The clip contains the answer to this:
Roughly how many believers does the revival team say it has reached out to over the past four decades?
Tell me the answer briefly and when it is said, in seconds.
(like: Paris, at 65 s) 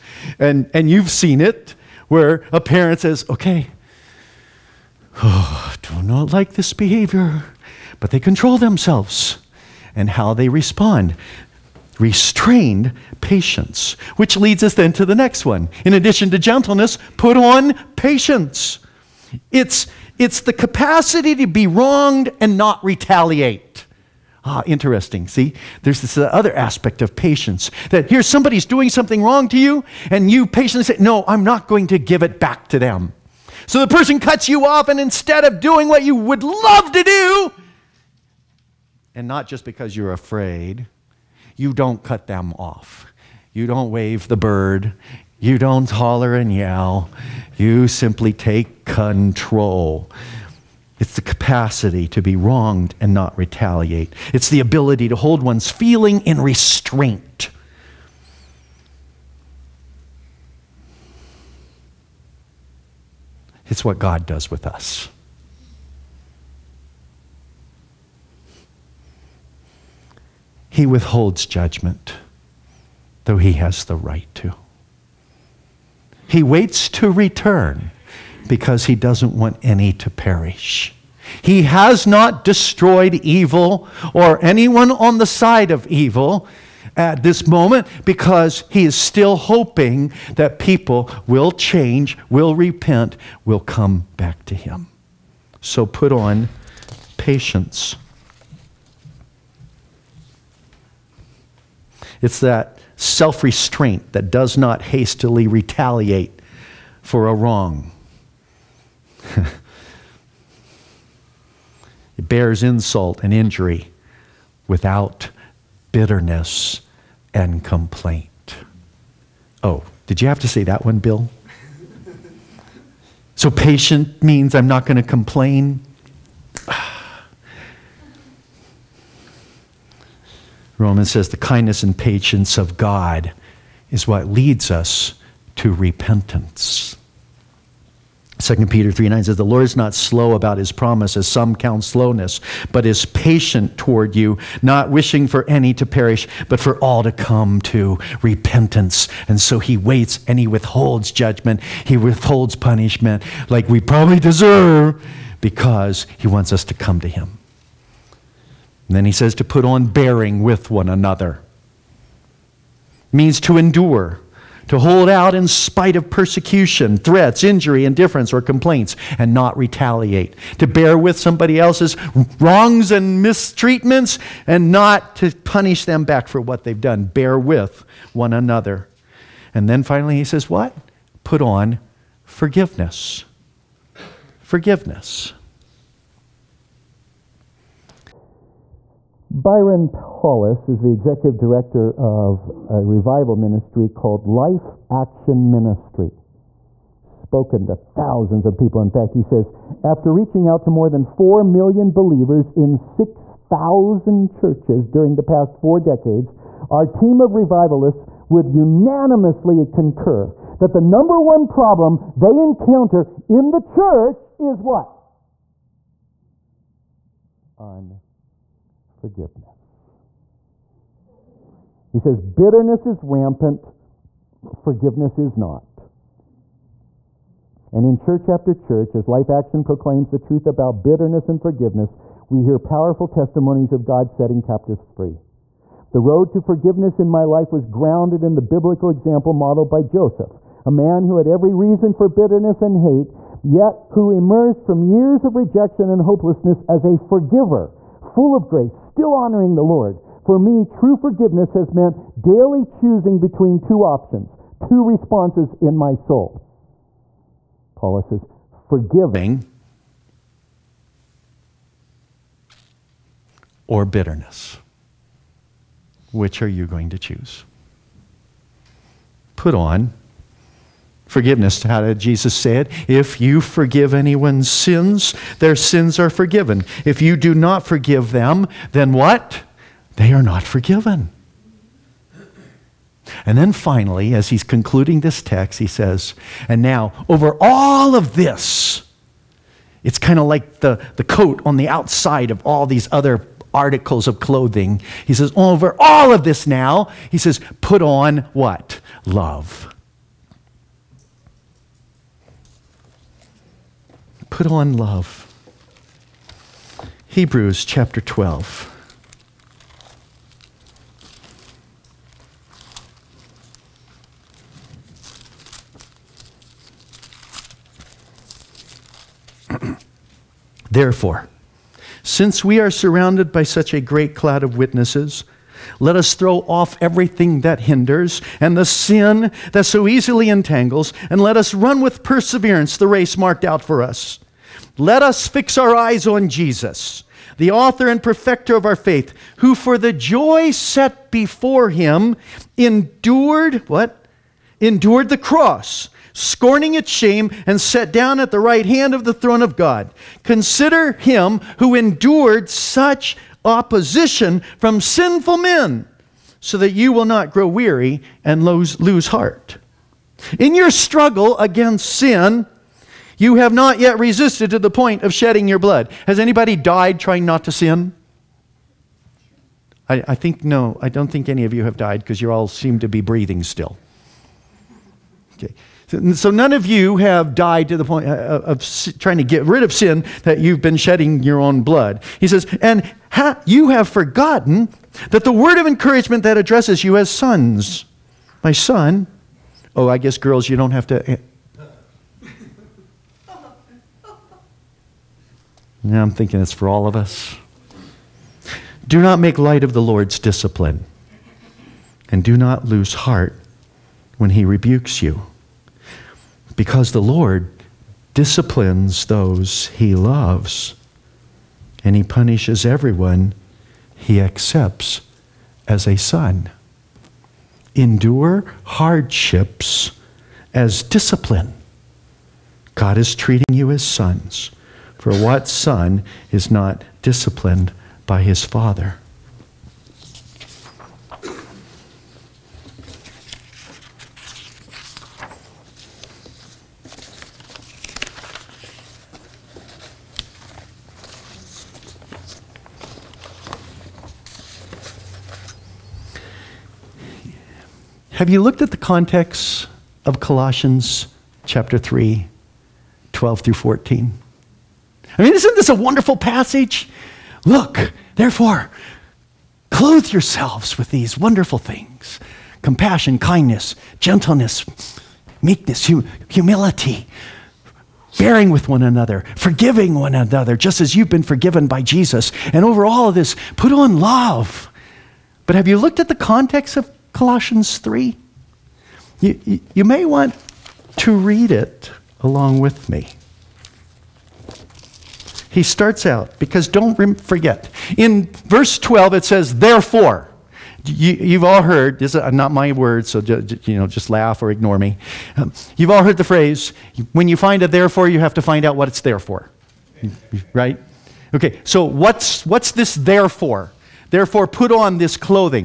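4 million, at 201 s.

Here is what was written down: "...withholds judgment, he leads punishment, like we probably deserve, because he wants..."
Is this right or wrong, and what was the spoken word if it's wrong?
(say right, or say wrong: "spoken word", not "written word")
wrong: "withholds", not "leads".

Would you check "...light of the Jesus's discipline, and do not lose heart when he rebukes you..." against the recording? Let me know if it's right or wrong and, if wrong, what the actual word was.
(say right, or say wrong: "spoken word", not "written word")
wrong: "Lord", not "Jesus".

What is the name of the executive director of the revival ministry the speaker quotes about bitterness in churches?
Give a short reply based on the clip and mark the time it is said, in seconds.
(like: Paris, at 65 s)
Byron Paulus, at 189 s.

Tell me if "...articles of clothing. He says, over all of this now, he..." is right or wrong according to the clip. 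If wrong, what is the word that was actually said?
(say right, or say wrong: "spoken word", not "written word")
right.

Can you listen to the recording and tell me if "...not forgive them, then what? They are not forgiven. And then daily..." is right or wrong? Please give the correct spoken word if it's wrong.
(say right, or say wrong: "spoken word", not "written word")
wrong: "finally", not "daily".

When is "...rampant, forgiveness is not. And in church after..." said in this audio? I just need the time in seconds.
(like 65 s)
223 s.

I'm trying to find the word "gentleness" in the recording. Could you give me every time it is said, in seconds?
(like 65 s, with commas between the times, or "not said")
16 s, 463 s.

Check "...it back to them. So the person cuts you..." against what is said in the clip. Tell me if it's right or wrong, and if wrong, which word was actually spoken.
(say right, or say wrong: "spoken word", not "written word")
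right.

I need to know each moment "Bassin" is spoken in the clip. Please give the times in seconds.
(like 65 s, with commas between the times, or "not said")
not said.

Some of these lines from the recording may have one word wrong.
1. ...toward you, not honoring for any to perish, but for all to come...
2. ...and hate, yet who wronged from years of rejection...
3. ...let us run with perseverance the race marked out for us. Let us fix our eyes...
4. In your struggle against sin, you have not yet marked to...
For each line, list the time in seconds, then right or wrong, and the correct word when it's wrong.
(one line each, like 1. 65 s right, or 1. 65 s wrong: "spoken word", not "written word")
1. 143 s wrong: "wishing", not "honoring"
2. 242 s wrong: "emerged", not "wronged"
3. 331 s right
4. 360 s wrong: "resisted", not "marked".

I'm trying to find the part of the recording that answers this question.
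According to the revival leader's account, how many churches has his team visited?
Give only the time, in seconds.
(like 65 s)
202 s.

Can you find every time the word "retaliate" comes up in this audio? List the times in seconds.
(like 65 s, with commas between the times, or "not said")
22 s, 53 s, 105 s, 169 s.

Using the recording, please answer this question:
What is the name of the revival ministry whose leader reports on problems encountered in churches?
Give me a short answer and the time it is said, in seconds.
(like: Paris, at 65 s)
Life Action Ministry, at 194 s.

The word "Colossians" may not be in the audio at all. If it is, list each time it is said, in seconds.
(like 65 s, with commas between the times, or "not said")
450 s, 477 s.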